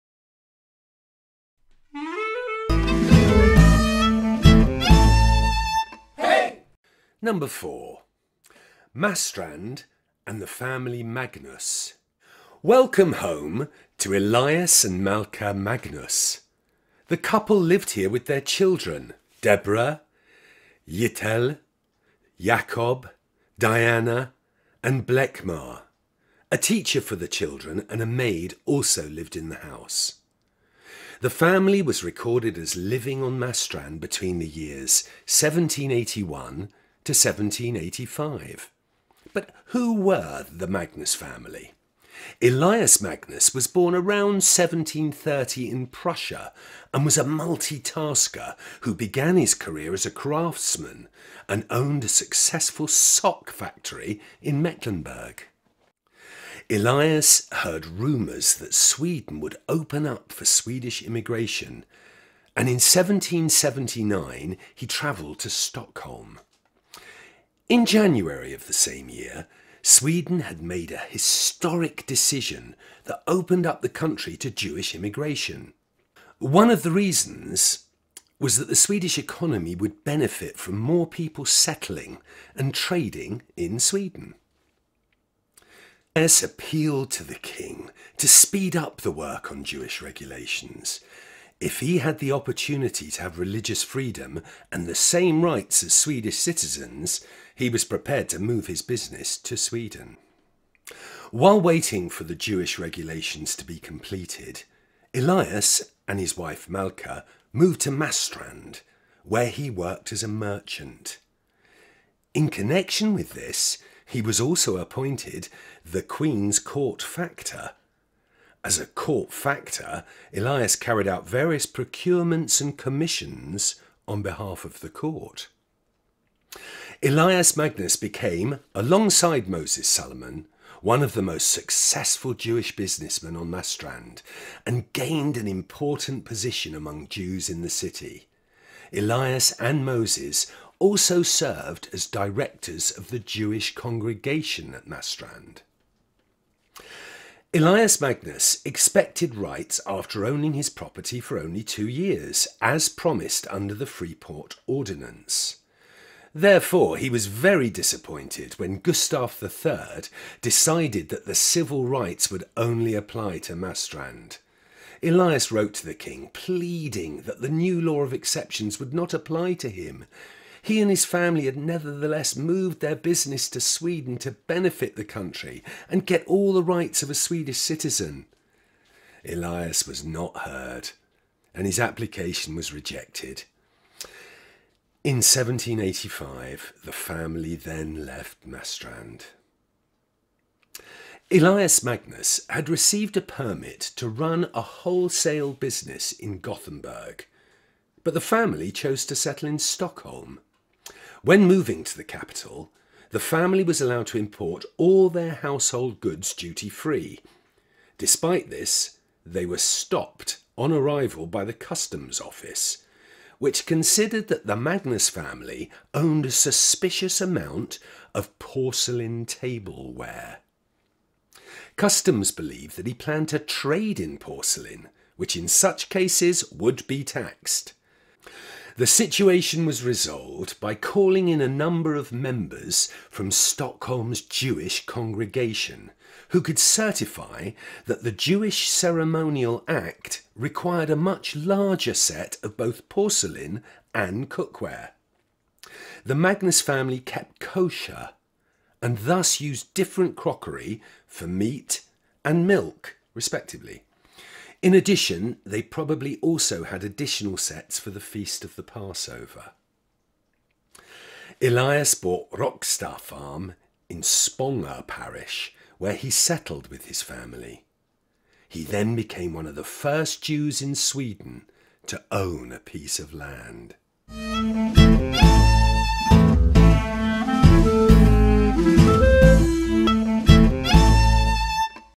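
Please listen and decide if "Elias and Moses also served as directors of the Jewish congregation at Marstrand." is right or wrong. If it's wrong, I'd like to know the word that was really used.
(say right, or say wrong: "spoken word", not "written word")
right.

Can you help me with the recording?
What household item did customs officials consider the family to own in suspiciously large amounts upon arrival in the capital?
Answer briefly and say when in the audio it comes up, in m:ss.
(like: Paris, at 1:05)
Porcelain tableware, at 3:38.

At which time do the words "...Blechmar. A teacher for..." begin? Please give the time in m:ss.
0:25.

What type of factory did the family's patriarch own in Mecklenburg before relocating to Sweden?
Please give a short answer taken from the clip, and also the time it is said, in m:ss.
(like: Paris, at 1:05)
Sock factory, at 0:52.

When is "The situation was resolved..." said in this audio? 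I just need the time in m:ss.
3:48.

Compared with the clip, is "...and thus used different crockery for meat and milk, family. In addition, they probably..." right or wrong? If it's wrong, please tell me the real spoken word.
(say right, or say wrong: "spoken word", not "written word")
wrong: "respectively", not "family".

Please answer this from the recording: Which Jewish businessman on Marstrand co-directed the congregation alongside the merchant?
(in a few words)
Moses Salomon.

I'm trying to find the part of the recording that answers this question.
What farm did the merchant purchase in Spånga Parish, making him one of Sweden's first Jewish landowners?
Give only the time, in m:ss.
4:22.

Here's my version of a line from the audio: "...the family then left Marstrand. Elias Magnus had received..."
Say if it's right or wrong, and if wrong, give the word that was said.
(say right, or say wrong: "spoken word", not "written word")
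right.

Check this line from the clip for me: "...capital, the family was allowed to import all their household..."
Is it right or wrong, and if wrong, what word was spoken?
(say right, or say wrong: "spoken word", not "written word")
right.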